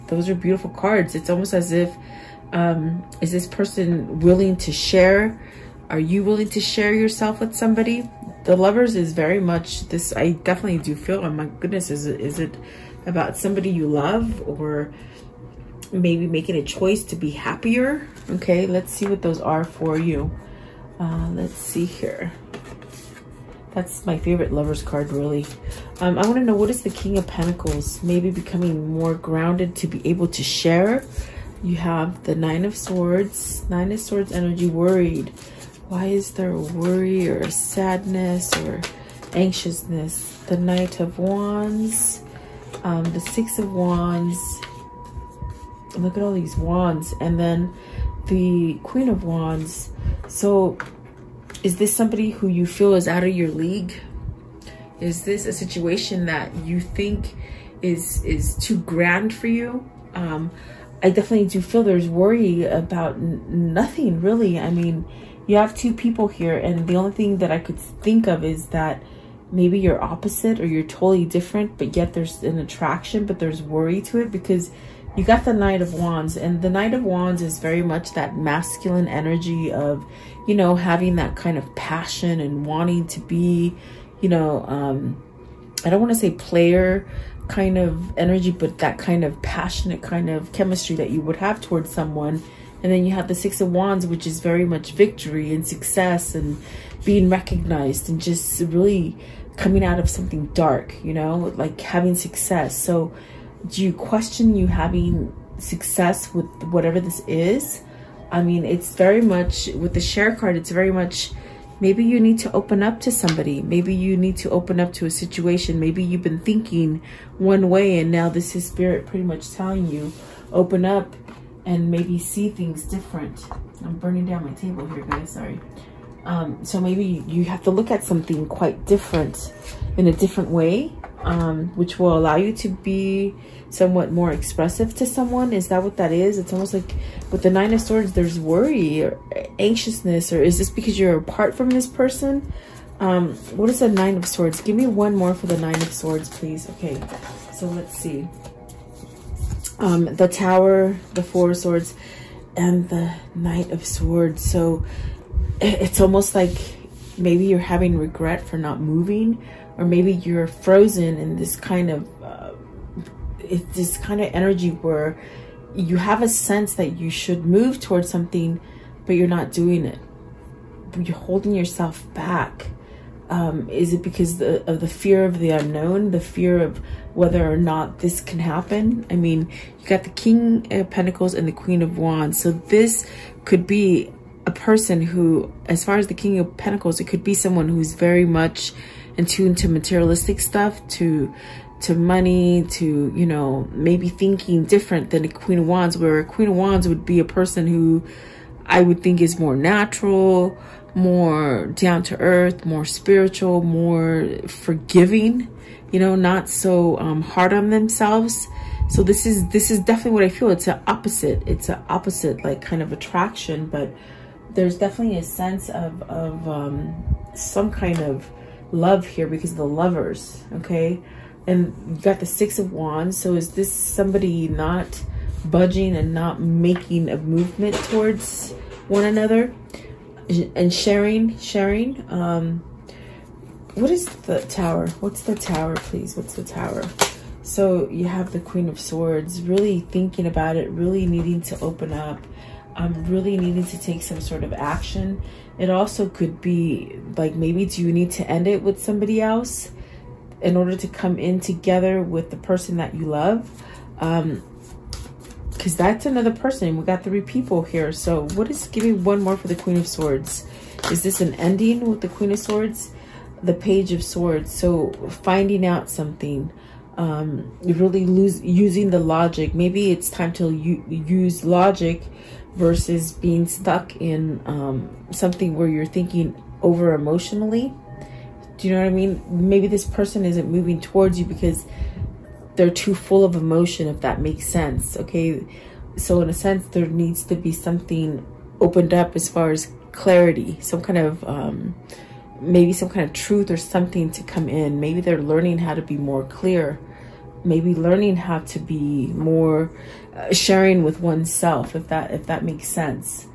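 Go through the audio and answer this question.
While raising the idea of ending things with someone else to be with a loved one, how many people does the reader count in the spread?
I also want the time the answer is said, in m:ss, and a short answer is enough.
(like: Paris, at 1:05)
3, at 4:17.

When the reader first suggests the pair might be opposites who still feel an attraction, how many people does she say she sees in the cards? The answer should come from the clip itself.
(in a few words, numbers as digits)
2.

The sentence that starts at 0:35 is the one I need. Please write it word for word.
Why is there worry or sadness or anxiousness?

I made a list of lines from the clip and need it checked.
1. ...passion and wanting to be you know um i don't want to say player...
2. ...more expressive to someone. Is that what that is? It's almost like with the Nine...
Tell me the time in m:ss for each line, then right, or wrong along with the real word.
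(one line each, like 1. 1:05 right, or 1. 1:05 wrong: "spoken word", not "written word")
1. 1:21 right
2. 2:14 right.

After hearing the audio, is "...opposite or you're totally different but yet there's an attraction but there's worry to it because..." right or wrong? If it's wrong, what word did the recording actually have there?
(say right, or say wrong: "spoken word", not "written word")
right.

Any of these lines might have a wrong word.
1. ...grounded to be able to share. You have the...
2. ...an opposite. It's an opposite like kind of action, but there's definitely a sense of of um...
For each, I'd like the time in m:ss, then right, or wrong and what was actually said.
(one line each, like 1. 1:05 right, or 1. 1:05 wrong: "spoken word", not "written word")
1. 0:29 right
2. 3:30 wrong: "attraction", not "action".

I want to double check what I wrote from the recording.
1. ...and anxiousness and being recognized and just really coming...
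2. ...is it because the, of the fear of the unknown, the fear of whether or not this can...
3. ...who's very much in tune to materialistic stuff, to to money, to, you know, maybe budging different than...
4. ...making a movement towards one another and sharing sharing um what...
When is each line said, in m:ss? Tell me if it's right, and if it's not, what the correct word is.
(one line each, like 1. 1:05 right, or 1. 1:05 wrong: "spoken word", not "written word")
1. 1:35 wrong: "success", not "anxiousness"
2. 2:53 right
3. 3:07 wrong: "thinking", not "budging"
4. 3:46 right.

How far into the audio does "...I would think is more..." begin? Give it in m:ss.
3:18.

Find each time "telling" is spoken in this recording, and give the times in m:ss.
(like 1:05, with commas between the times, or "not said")
1:59.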